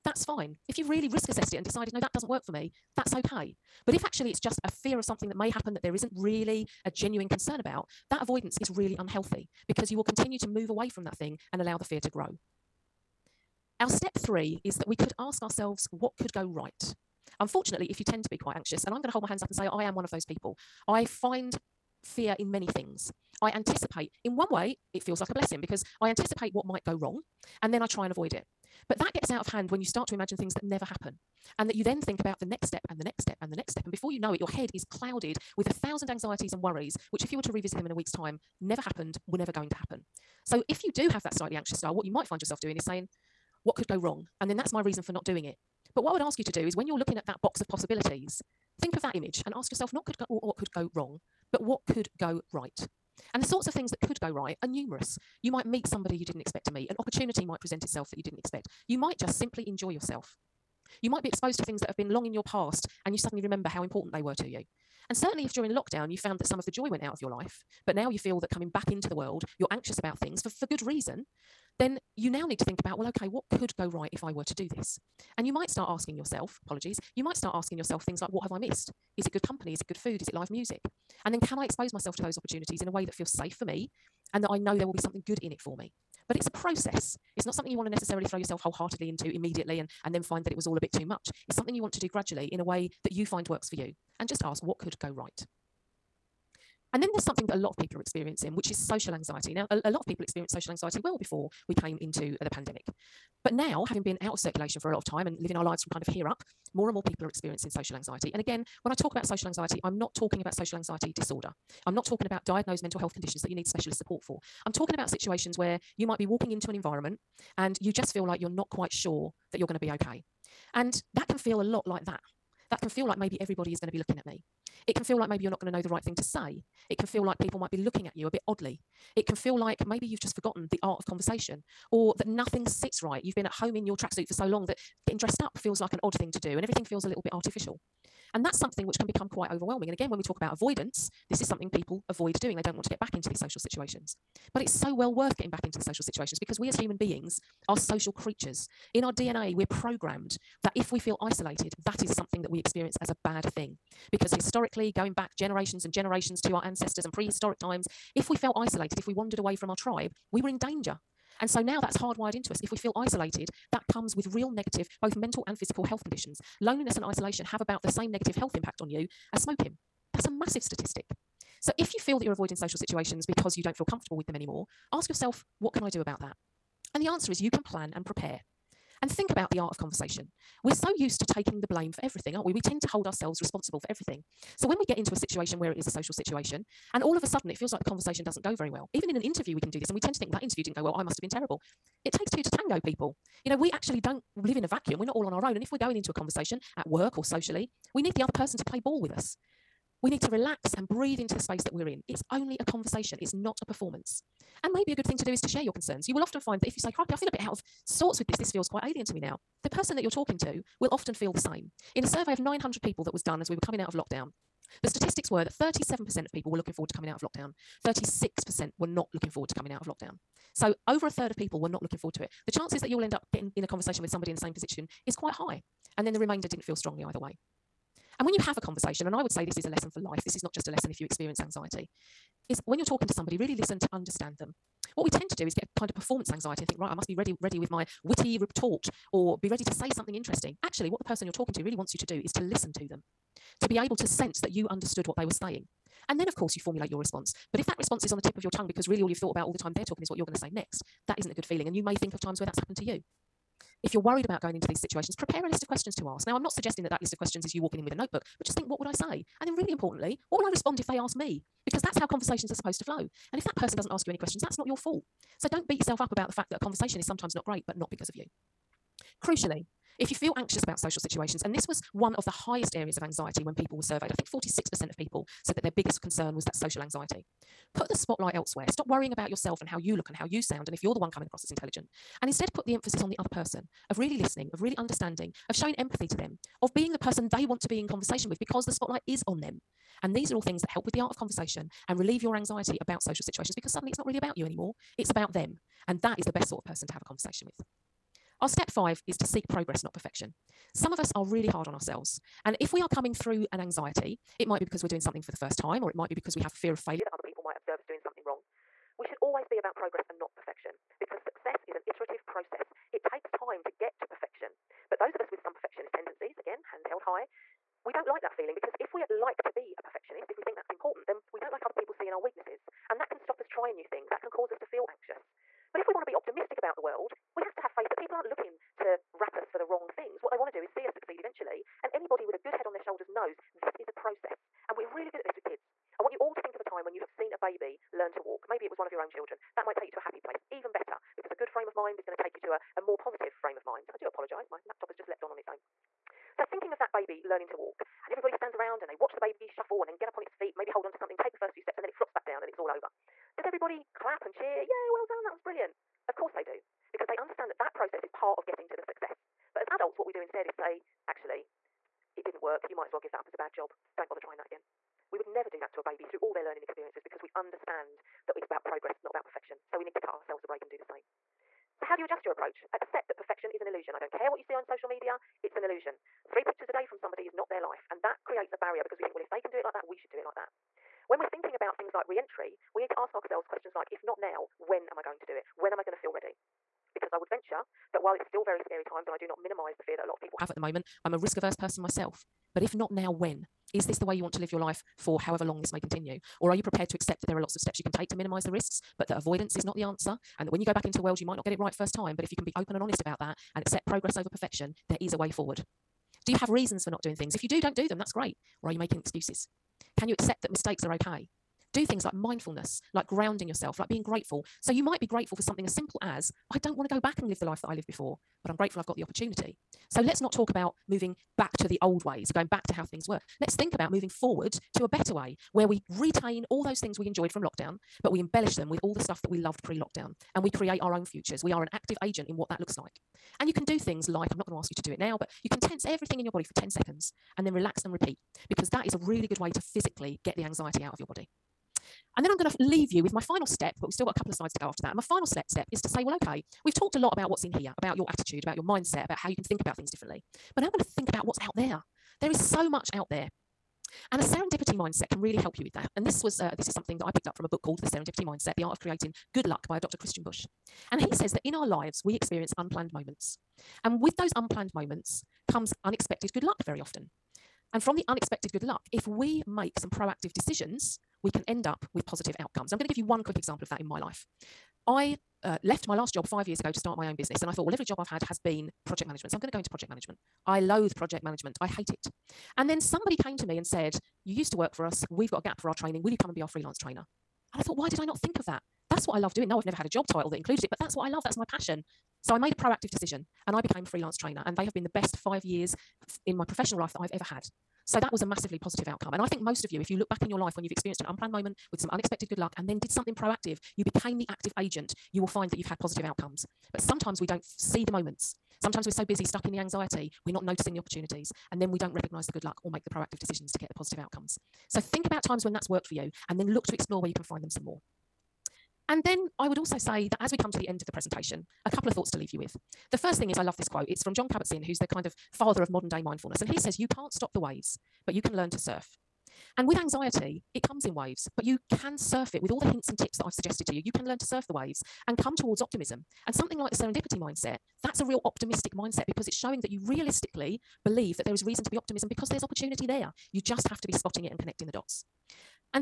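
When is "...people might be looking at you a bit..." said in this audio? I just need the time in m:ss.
2:07.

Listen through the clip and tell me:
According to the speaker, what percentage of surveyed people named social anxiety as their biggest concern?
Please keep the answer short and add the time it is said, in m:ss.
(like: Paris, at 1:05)
46%, at 4:34.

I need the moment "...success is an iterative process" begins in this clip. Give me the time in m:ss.
5:11.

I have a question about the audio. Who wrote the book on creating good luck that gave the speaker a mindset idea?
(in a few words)
Dr. Christian Busch.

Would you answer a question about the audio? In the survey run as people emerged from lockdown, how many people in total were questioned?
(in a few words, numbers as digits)
900.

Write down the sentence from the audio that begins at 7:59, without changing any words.
So I'm going to go into project management.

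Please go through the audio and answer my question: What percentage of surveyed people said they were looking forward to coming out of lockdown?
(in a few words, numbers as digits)
37%.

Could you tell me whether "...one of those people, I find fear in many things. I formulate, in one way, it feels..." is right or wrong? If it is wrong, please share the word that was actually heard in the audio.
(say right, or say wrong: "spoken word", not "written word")
wrong: "anticipate", not "formulate".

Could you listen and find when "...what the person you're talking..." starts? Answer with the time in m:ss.
4:00.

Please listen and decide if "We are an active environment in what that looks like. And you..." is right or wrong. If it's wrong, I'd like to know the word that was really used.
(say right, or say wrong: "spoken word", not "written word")
wrong: "agent", not "environment".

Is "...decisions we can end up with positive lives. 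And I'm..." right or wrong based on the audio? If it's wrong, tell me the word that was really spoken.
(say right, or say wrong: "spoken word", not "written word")
wrong: "outcomes", not "lives".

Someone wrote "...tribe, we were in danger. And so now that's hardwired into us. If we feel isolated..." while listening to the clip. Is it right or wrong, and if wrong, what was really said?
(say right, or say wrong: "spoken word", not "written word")
right.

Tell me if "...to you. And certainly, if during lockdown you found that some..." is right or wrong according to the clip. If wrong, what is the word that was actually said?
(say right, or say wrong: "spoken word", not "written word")
right.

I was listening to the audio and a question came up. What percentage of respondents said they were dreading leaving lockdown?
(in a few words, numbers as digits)
36%.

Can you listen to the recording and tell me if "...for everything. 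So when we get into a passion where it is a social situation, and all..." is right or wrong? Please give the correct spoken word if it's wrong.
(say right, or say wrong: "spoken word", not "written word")
wrong: "situation", not "passion".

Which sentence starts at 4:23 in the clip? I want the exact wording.
And if that person doesn't ask you any questions, that's not your fault.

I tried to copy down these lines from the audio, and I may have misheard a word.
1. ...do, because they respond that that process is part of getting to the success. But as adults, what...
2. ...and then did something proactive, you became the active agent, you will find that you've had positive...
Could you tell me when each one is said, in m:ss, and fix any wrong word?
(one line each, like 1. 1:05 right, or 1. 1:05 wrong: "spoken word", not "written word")
1. 5:56 wrong: "understand", not "respond"
2. 8:22 right.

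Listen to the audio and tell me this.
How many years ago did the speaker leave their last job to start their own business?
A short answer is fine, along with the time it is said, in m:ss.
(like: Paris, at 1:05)
5, at 7:56.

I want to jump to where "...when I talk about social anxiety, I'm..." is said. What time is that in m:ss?
1:48.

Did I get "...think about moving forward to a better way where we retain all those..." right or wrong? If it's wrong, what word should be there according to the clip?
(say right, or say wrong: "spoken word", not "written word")
right.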